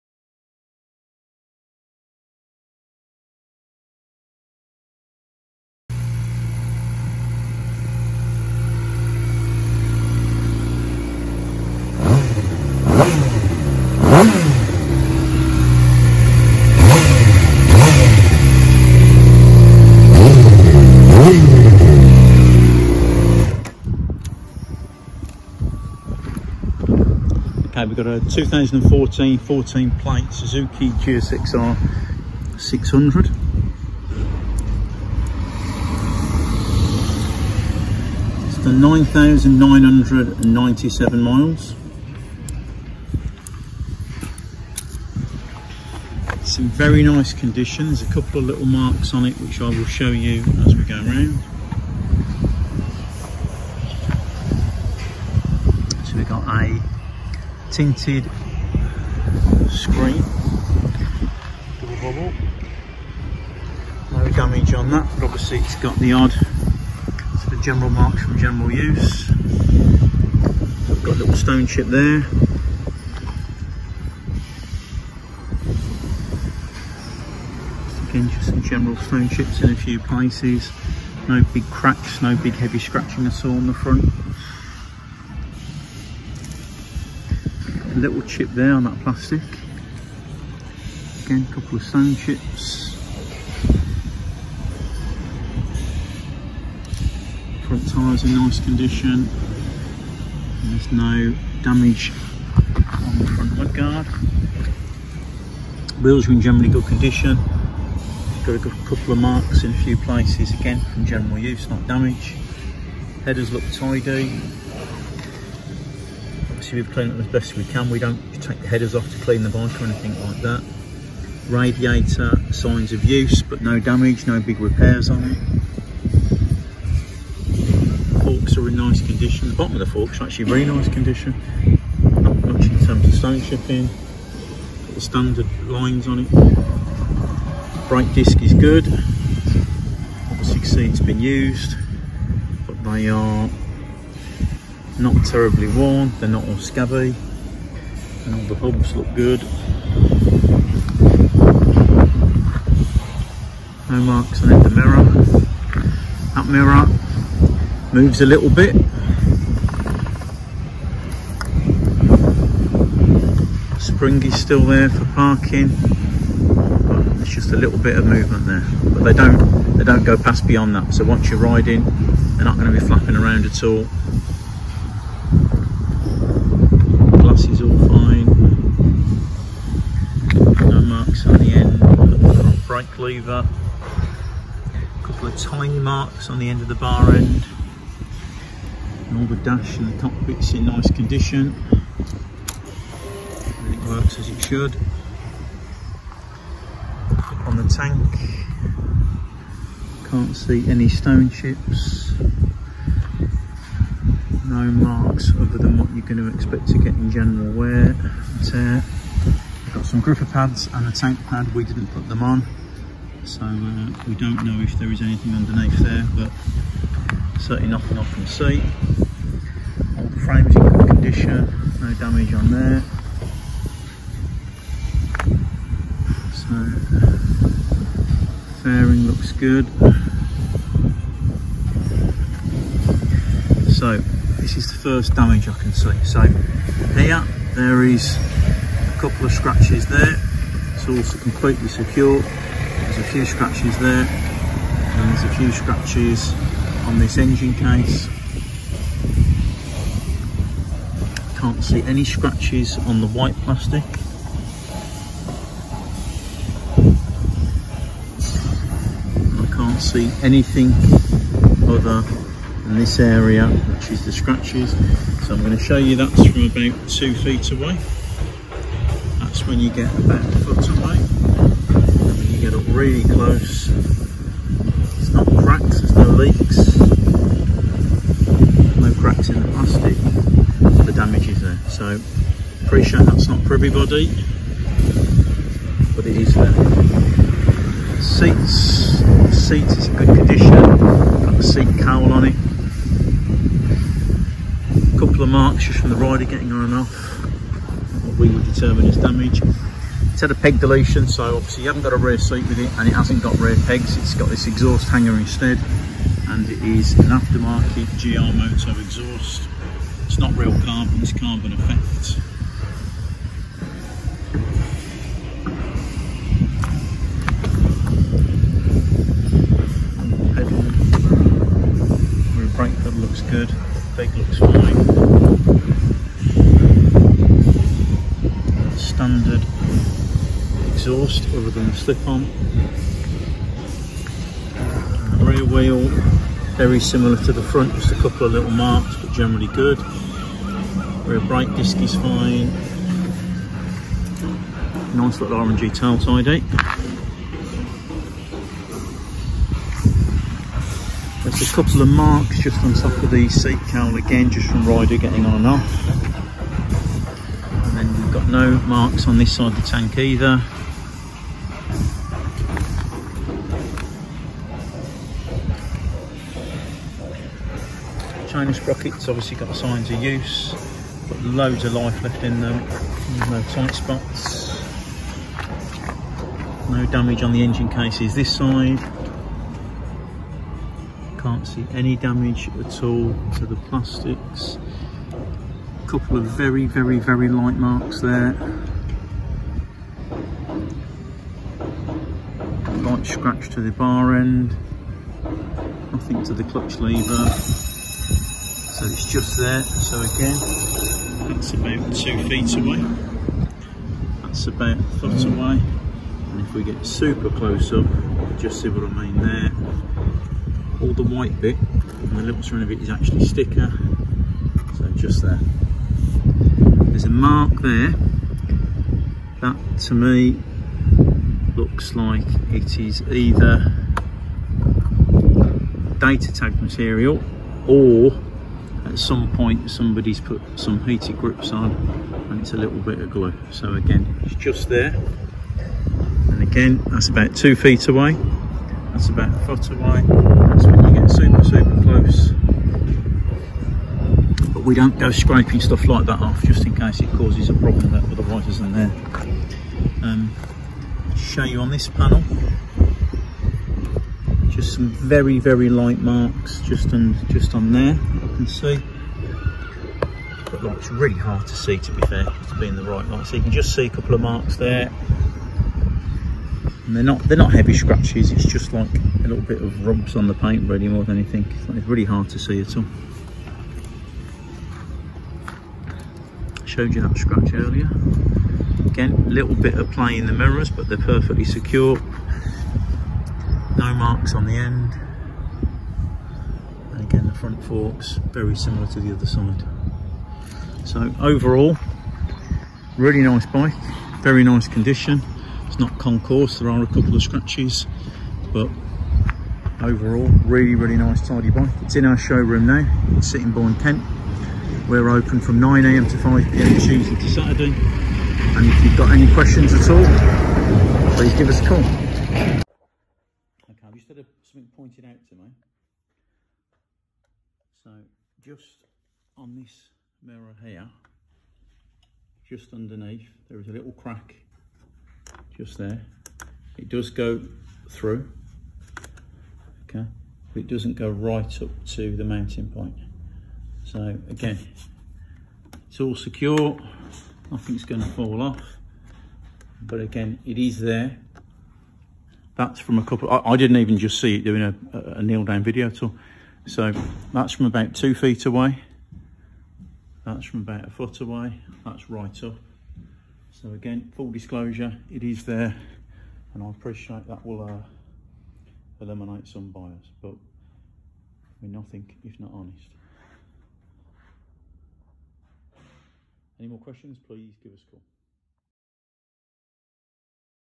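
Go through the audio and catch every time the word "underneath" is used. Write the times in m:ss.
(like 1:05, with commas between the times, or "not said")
3:35, 8:42.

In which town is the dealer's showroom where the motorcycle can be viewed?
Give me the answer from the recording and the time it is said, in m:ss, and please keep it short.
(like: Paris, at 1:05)
Sittingbourne, at 8:23.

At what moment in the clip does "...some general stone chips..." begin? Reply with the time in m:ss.
1:18.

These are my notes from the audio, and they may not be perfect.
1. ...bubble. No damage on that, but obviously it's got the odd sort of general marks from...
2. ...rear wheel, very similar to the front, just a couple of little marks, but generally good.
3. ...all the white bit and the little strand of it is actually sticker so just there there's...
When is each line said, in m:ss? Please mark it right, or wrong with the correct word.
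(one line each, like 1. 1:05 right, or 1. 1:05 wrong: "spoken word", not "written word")
1. 1:02 right
2. 5:35 right
3. 6:50 right.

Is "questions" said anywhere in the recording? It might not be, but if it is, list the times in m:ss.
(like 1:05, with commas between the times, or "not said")
8:29, 9:26.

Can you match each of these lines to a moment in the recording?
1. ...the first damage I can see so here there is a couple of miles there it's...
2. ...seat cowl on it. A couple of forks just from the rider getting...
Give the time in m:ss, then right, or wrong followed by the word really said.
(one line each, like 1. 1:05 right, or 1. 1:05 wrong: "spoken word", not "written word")
1. 3:54 wrong: "scratches", not "miles"
2. 4:51 wrong: "marks", not "forks".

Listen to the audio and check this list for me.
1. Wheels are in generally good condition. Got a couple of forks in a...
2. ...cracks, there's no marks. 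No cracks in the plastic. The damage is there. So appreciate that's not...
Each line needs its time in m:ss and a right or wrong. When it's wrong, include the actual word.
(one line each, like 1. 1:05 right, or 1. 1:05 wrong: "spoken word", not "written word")
1. 1:46 wrong: "marks", not "forks"
2. 4:35 wrong: "leaks", not "marks".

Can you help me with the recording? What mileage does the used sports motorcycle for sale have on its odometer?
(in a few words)
9,997 miles.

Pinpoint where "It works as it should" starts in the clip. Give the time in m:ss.
3:13.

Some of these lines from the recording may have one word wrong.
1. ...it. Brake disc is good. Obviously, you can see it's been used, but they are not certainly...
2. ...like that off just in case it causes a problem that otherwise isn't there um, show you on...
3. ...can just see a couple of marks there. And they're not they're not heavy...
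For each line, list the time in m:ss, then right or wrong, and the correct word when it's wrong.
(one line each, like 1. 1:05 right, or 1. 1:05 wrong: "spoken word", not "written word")
1. 2:16 wrong: "terribly", not "certainly"
2. 7:25 right
3. 7:43 right.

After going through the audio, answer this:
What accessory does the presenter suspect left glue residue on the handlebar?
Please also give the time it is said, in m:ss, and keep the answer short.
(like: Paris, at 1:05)
Heated grips, at 7:10.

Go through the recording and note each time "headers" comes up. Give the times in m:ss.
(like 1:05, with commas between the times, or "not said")
1:53, 1:58.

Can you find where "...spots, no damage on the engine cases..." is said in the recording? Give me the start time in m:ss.
6:13.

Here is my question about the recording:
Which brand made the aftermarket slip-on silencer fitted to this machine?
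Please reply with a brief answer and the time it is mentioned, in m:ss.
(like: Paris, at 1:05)
GR Moto, at 5:07.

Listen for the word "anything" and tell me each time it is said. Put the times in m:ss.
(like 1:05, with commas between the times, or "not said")
1:59, 3:35, 4:20, 7:51.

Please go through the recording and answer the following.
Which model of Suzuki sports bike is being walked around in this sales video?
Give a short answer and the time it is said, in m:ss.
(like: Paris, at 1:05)
GSXR 600, at 0:30.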